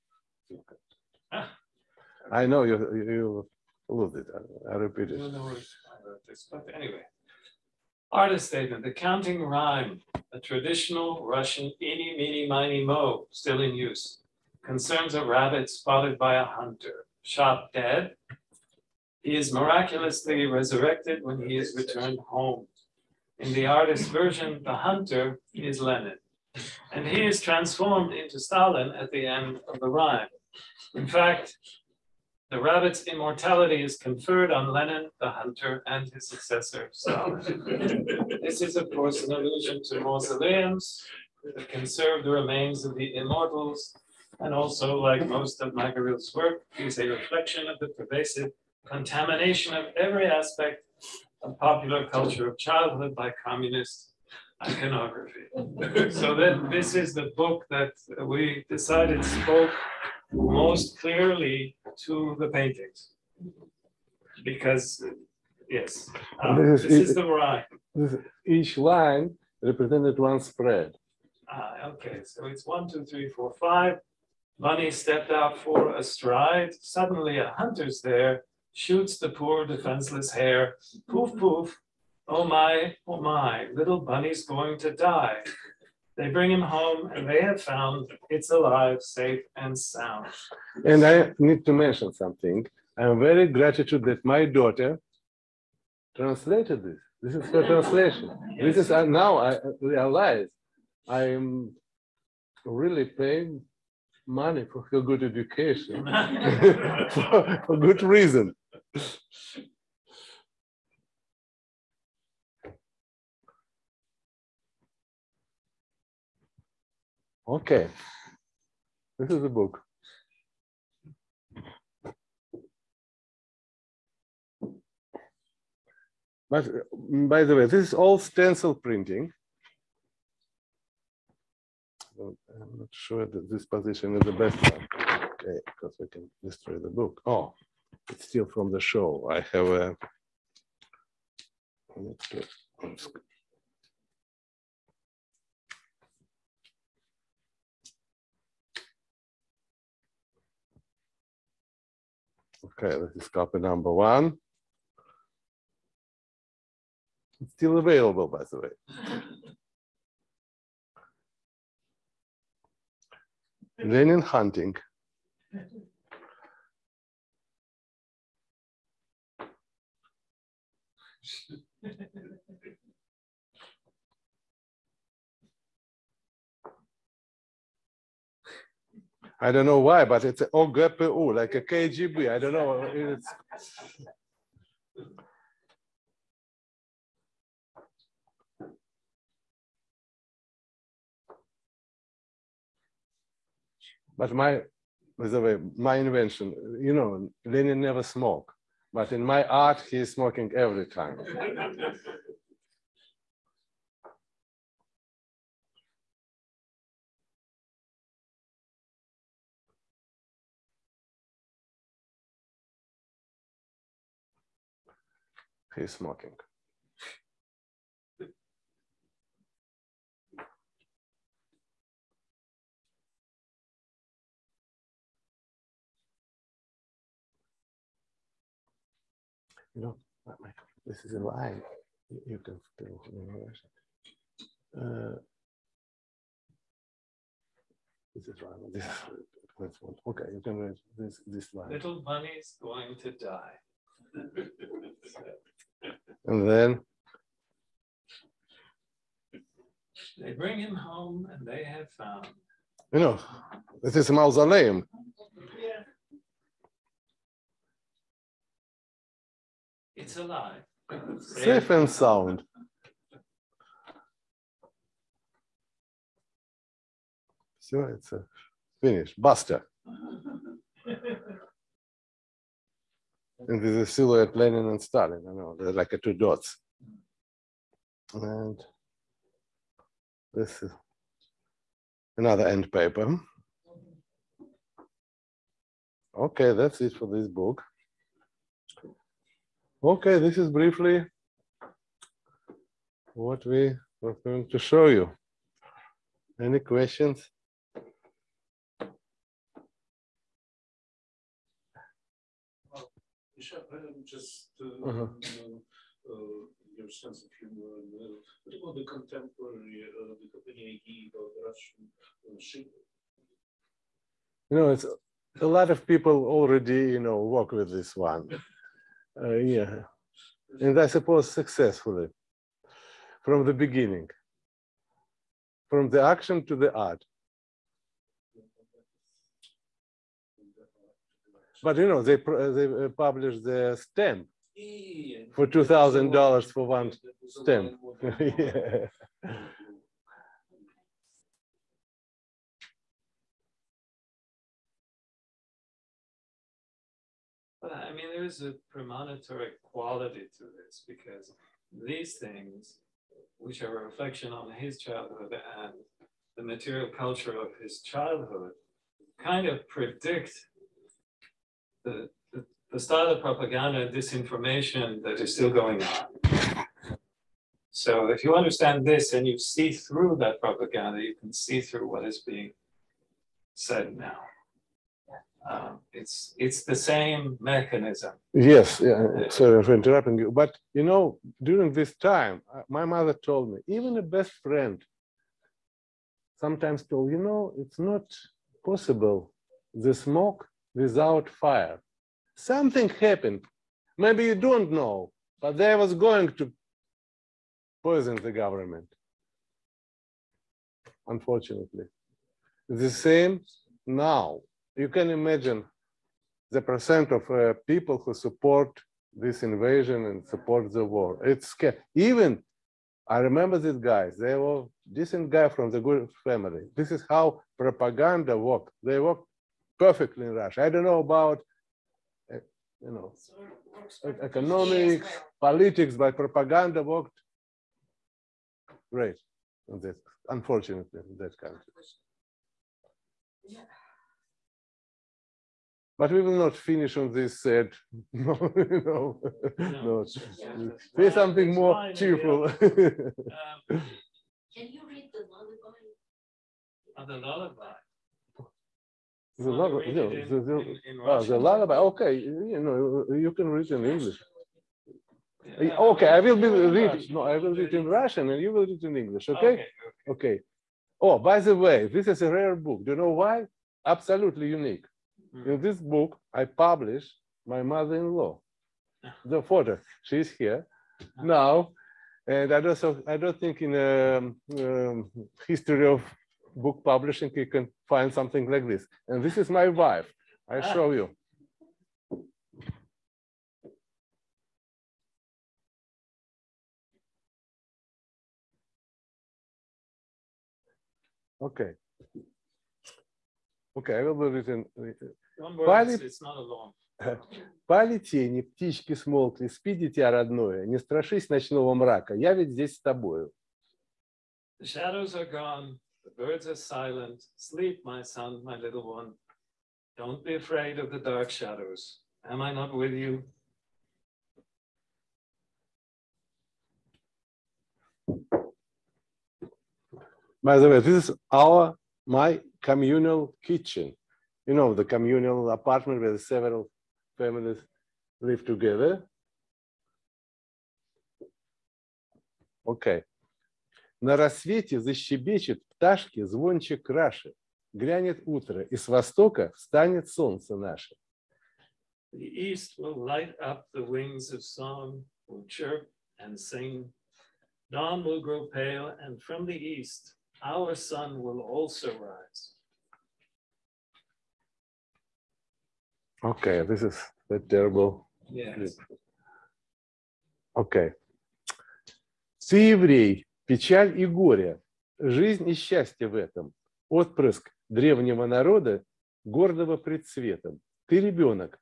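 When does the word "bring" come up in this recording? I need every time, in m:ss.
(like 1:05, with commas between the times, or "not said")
1:26, 4:10.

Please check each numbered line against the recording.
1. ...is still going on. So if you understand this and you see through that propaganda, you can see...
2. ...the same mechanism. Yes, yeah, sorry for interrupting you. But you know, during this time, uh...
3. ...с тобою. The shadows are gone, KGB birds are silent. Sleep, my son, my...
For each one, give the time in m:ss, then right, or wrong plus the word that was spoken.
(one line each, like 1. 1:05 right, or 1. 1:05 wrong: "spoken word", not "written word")
1. 6:05 right
2. 6:16 right
3. 8:22 wrong: "The", not "KGB".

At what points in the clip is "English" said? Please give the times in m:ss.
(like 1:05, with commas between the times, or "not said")
7:33, 7:38.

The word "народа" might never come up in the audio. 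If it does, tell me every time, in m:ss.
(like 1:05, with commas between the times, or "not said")
9:28.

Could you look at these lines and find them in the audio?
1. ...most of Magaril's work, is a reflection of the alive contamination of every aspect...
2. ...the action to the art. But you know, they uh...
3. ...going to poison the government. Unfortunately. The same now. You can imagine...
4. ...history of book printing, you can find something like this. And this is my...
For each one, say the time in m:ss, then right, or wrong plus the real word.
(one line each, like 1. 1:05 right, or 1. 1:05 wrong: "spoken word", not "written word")
1. 0:45 wrong: "pervasive", not "alive"
2. 5:25 right
3. 6:35 right
4. 7:55 wrong: "publishing", not "printing".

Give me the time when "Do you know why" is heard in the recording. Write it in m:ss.
7:42.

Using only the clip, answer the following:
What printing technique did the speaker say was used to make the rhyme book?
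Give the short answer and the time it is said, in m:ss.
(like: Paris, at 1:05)
Stencil printing, at 2:08.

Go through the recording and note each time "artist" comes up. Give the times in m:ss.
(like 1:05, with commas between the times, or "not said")
0:08, 0:23.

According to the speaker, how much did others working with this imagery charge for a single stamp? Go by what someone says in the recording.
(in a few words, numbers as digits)
$2,000.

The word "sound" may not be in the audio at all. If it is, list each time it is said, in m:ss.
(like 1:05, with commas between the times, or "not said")
1:29, 4:21.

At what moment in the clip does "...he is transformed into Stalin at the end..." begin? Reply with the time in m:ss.
0:27.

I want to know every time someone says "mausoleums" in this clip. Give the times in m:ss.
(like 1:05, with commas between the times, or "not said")
0:40, 4:14.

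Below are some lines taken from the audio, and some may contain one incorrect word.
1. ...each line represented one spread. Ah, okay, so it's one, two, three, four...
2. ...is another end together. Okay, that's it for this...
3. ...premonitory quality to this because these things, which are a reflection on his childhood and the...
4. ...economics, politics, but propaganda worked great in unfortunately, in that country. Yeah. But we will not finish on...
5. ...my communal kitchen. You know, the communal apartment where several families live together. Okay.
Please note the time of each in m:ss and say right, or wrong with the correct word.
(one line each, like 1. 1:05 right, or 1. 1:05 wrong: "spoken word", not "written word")
1. 1:08 right
2. 4:40 wrong: "paper", not "together"
3. 5:48 right
4. 7:04 right
5. 8:42 right.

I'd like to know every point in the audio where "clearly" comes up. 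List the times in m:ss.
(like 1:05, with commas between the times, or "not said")
1:00.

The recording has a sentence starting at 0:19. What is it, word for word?
He is miraculously resurrected when he is returned home.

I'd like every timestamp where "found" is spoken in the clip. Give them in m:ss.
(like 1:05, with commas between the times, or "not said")
1:27, 4:11.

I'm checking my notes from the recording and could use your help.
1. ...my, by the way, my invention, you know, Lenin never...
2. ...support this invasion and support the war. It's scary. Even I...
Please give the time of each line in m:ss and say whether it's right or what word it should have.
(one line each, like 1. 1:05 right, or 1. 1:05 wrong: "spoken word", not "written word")
1. 3:14 right
2. 6:48 right.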